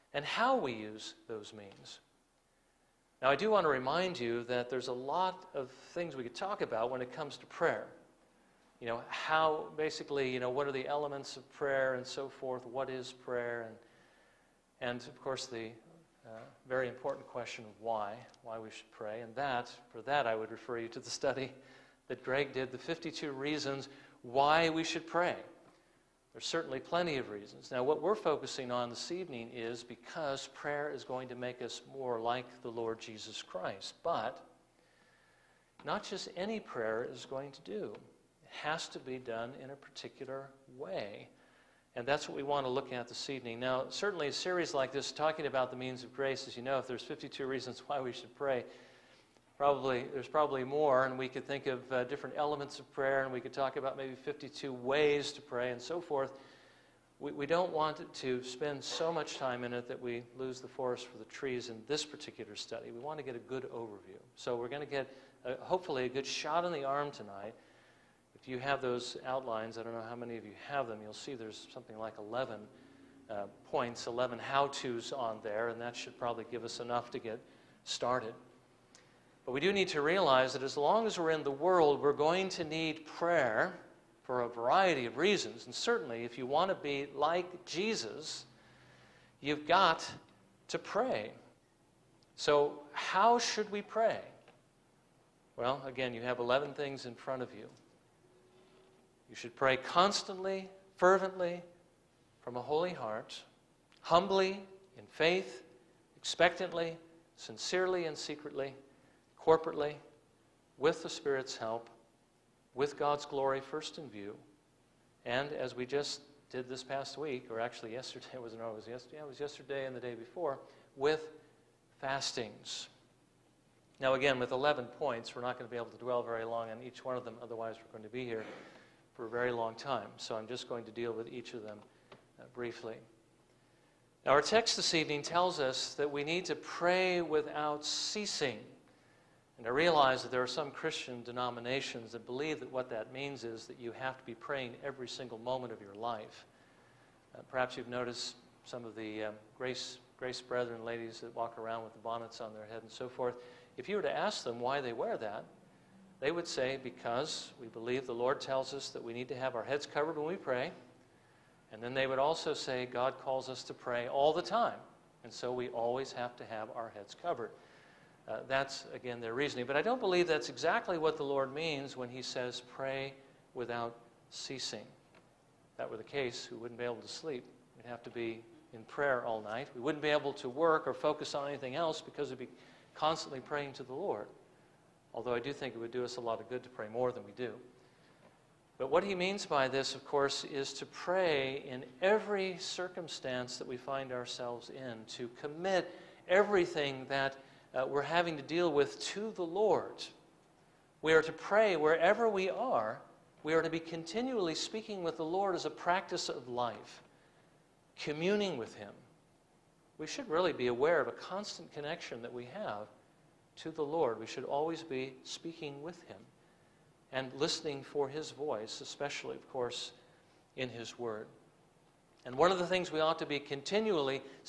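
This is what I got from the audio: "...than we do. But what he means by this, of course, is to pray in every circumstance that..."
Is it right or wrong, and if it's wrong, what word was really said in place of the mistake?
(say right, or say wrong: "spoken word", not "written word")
right.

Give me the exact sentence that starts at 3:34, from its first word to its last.
We should always be speaking with Him and listening for His voice, especially, of course, in His Word.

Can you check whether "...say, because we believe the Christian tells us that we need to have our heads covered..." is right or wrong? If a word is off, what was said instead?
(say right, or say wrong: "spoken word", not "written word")
wrong: "Lord", not "Christian".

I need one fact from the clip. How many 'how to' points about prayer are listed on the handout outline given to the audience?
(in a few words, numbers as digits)
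11.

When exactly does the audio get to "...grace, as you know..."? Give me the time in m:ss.
0:46.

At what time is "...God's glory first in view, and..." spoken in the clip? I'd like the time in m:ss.
1:52.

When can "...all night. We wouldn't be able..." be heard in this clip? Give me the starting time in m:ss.
2:59.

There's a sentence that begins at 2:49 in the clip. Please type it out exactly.
But I don't believe that's exactly what the Lord means when he says, pray without ceasing.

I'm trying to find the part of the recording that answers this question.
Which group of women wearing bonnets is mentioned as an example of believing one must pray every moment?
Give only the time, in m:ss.
2:30.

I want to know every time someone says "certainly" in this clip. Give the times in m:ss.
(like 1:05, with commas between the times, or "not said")
0:26, 0:43, 1:25.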